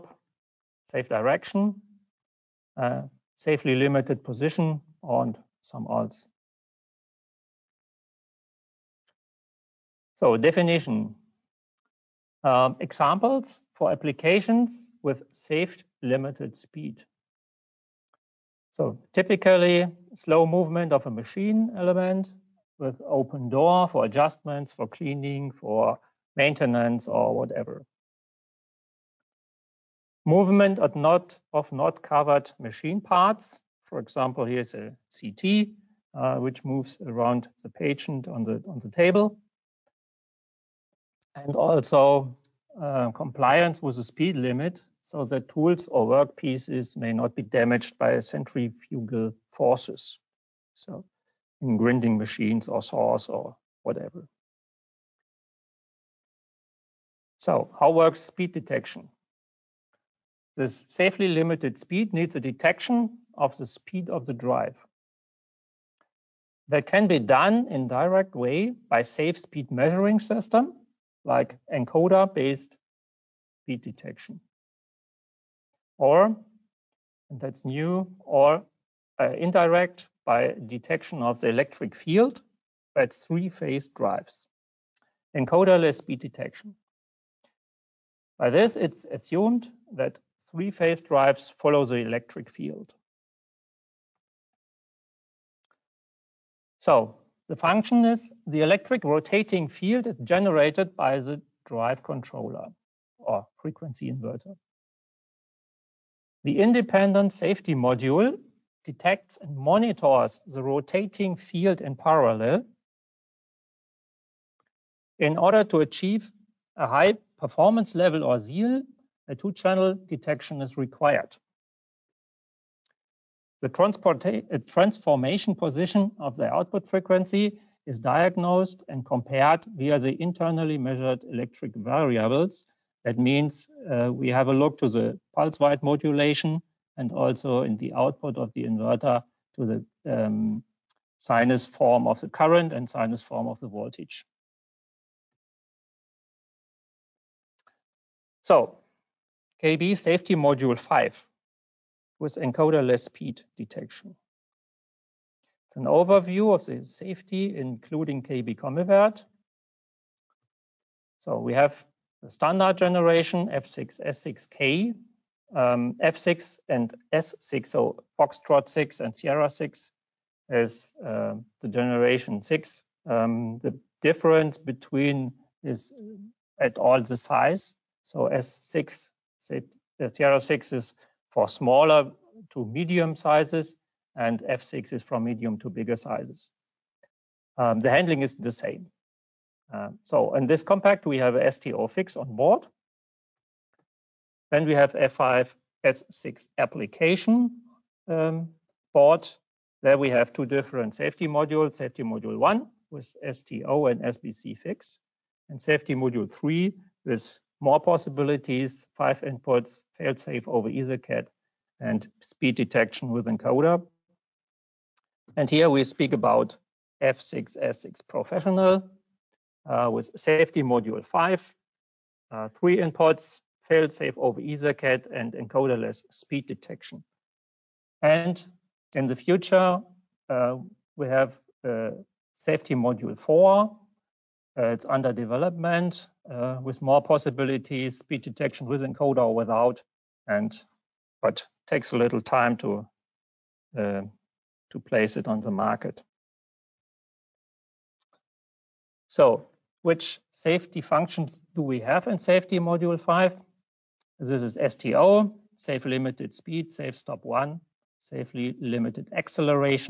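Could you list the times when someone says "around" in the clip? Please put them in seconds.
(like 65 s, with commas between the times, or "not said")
37 s.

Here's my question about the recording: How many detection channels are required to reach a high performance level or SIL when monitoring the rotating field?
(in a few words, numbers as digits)
2.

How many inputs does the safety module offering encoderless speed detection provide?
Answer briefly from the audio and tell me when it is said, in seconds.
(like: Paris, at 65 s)
3, at 222 s.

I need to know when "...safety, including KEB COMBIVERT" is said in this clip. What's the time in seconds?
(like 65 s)
156 s.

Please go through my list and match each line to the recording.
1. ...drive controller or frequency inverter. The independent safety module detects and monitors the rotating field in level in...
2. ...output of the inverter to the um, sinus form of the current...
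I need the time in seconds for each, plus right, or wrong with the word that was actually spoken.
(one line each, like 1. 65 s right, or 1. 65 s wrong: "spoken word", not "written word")
1. 101 s wrong: "parallel", not "level"
2. 137 s right.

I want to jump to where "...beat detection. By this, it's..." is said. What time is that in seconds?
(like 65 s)
86 s.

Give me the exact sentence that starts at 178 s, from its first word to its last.
So S6, say, uh, Sierra 6 is for smaller to medium sizes, and F6 is from medium to bigger sizes.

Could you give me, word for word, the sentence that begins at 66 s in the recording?
That can be done in direct way by safe speed measuring system like encoder-based beat detection.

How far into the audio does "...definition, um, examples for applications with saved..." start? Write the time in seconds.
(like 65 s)
10 s.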